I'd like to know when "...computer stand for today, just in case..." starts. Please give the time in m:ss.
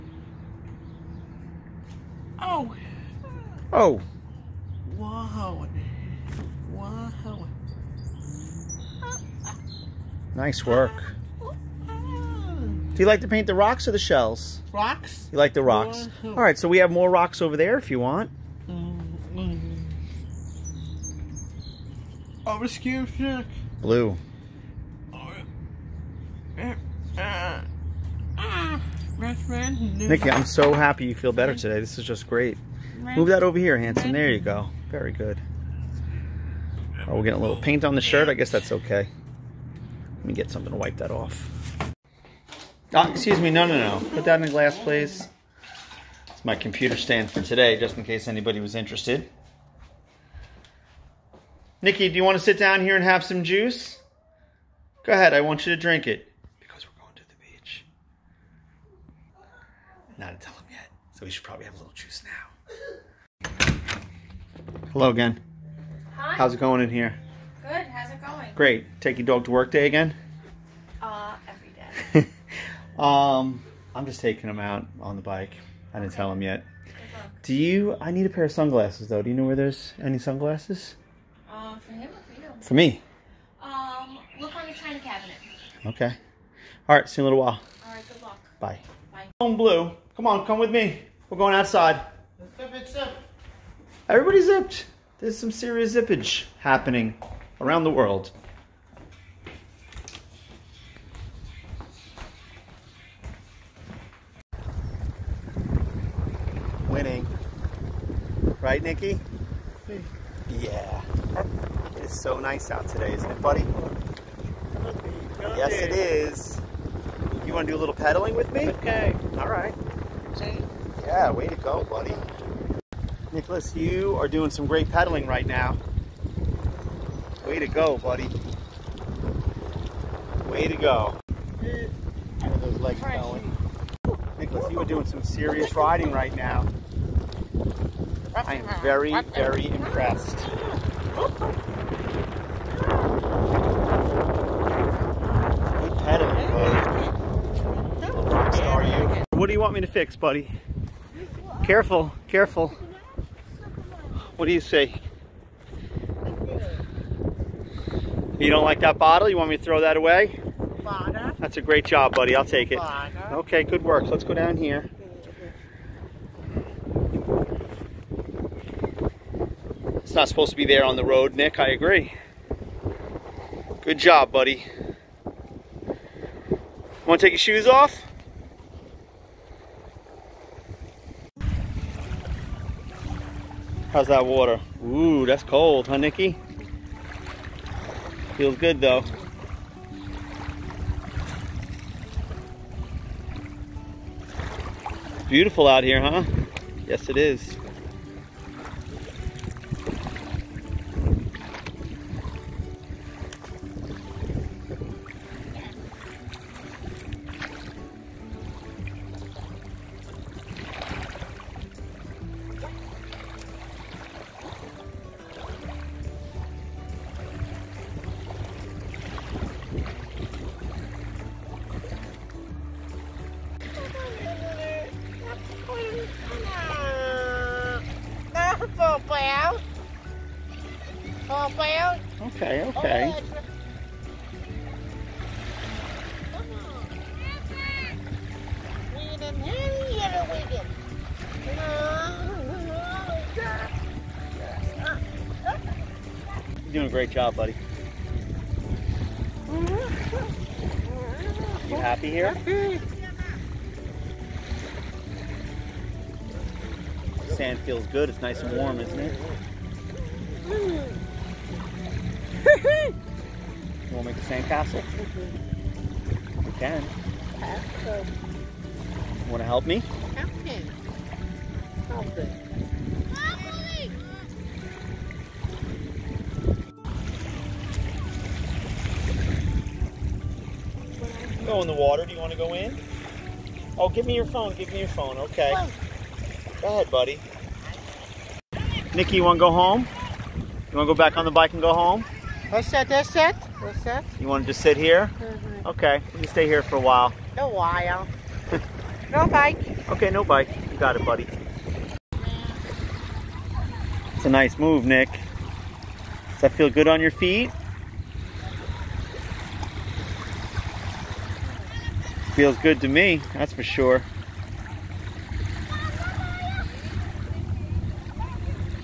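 0:46.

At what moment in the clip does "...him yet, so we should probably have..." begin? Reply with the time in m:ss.
1:00.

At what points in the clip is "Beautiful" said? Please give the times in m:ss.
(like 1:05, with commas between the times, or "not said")
3:15.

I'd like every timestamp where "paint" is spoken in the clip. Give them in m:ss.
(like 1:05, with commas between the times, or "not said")
0:13, 0:37.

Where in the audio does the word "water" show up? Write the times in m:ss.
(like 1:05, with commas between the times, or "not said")
3:04, 4:41.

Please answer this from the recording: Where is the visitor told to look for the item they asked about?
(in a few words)
The china cabinet.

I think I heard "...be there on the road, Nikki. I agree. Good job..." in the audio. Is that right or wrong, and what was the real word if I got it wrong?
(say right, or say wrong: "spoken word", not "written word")
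wrong: "Nick", not "Nikki".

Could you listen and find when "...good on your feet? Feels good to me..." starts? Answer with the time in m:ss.
5:06.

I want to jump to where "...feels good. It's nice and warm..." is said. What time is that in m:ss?
4:17.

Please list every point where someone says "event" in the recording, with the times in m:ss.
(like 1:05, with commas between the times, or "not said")
not said.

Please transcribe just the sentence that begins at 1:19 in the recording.
Do you know where there's any sunglasses?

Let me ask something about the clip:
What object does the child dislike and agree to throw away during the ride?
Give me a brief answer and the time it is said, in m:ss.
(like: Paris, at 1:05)
Bottle, at 2:38.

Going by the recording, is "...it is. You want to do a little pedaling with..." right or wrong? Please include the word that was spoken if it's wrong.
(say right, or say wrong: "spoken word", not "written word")
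right.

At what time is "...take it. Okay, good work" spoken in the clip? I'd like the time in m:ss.
2:42.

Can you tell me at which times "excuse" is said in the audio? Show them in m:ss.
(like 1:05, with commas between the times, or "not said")
0:22, 0:43.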